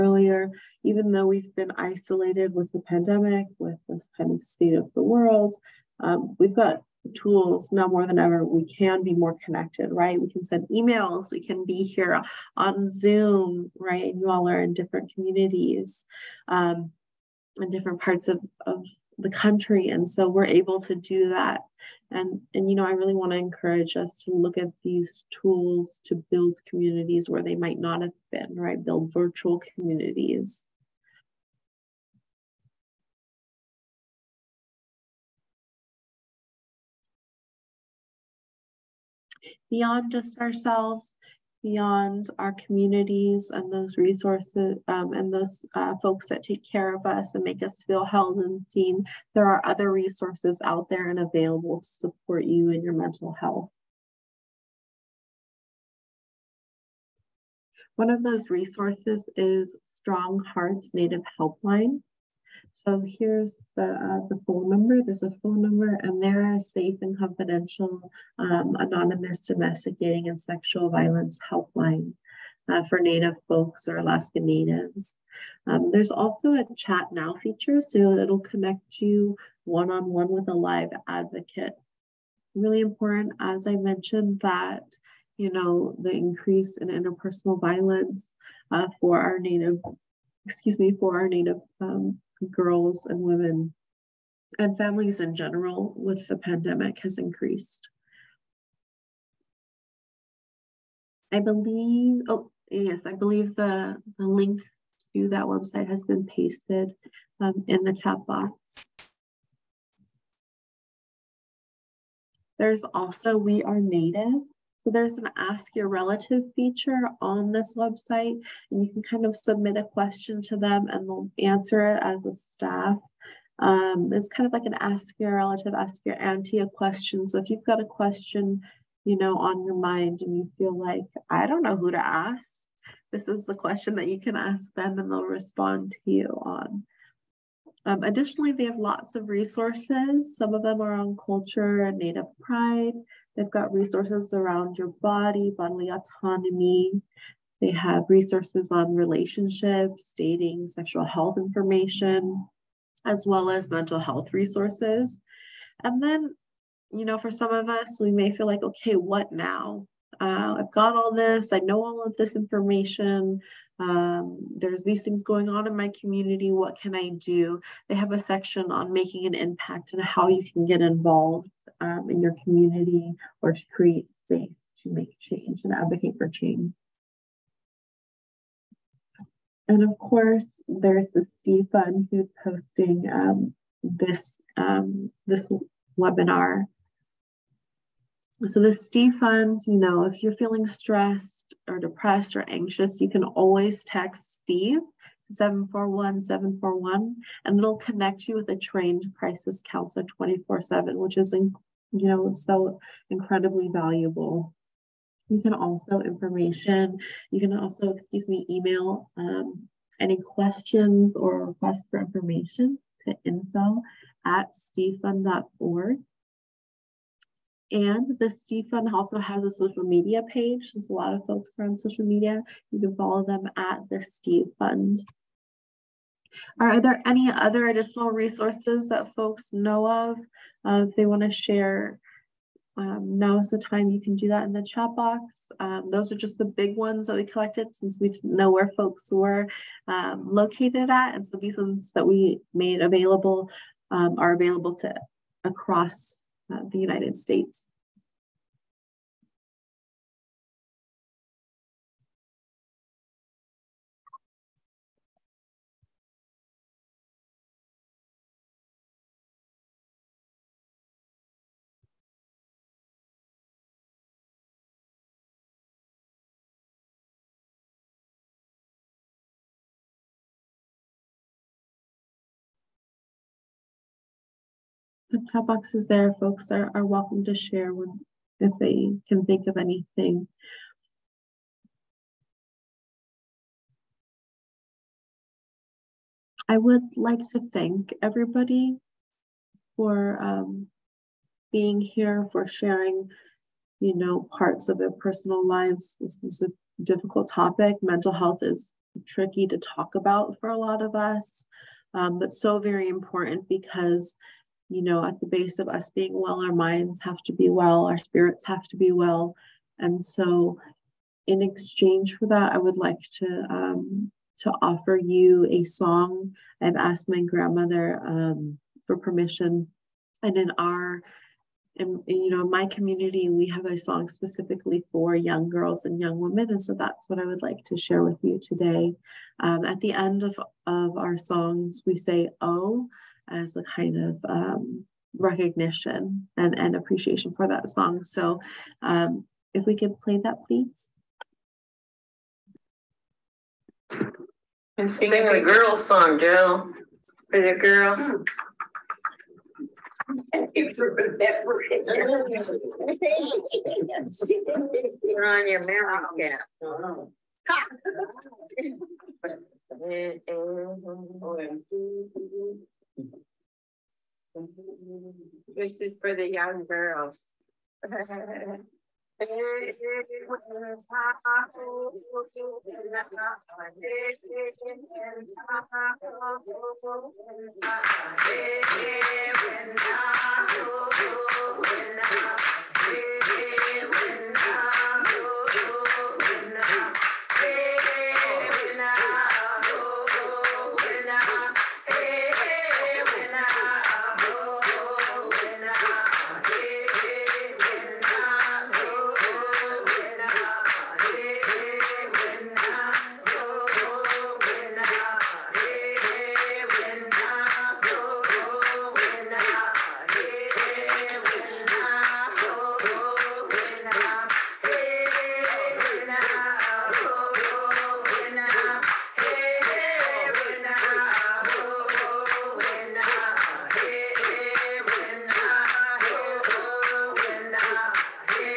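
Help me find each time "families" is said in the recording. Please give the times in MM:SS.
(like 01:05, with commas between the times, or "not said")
01:34.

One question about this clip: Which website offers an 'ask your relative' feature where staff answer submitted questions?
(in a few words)
We Are Native.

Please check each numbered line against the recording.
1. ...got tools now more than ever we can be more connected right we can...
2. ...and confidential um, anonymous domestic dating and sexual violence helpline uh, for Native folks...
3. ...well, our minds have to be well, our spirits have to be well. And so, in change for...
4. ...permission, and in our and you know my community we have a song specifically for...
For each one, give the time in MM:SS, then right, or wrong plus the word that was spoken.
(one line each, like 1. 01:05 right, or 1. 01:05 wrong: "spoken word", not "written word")
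1. 00:06 right
2. 01:07 right
3. 05:06 wrong: "exchange", not "change"
4. 05:18 right.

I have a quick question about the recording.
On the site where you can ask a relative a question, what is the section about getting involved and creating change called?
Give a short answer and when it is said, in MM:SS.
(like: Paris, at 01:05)
making an impact, at 02:48.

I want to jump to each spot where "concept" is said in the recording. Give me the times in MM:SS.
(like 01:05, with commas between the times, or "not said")
not said.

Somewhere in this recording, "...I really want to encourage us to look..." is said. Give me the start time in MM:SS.
00:22.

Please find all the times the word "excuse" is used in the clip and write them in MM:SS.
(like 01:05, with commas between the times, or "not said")
01:30, 03:27.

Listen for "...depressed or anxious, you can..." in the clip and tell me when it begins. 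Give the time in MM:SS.
03:11.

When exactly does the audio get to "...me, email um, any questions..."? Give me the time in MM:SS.
03:28.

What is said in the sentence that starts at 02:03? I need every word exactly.
Um, it's kind of like an ask your relative, ask your auntie a question.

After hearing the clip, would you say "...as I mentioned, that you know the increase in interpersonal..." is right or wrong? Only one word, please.
right.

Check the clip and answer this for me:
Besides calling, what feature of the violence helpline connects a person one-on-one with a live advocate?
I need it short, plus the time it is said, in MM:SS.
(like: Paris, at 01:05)
chat now, at 01:16.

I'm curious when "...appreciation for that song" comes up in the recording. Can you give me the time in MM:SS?
05:36.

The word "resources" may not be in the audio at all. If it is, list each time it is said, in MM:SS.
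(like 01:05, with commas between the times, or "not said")
00:43, 00:49, 00:58, 02:19, 02:23, 02:28, 02:34, 03:48.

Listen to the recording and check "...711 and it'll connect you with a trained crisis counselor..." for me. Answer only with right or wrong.
wrong.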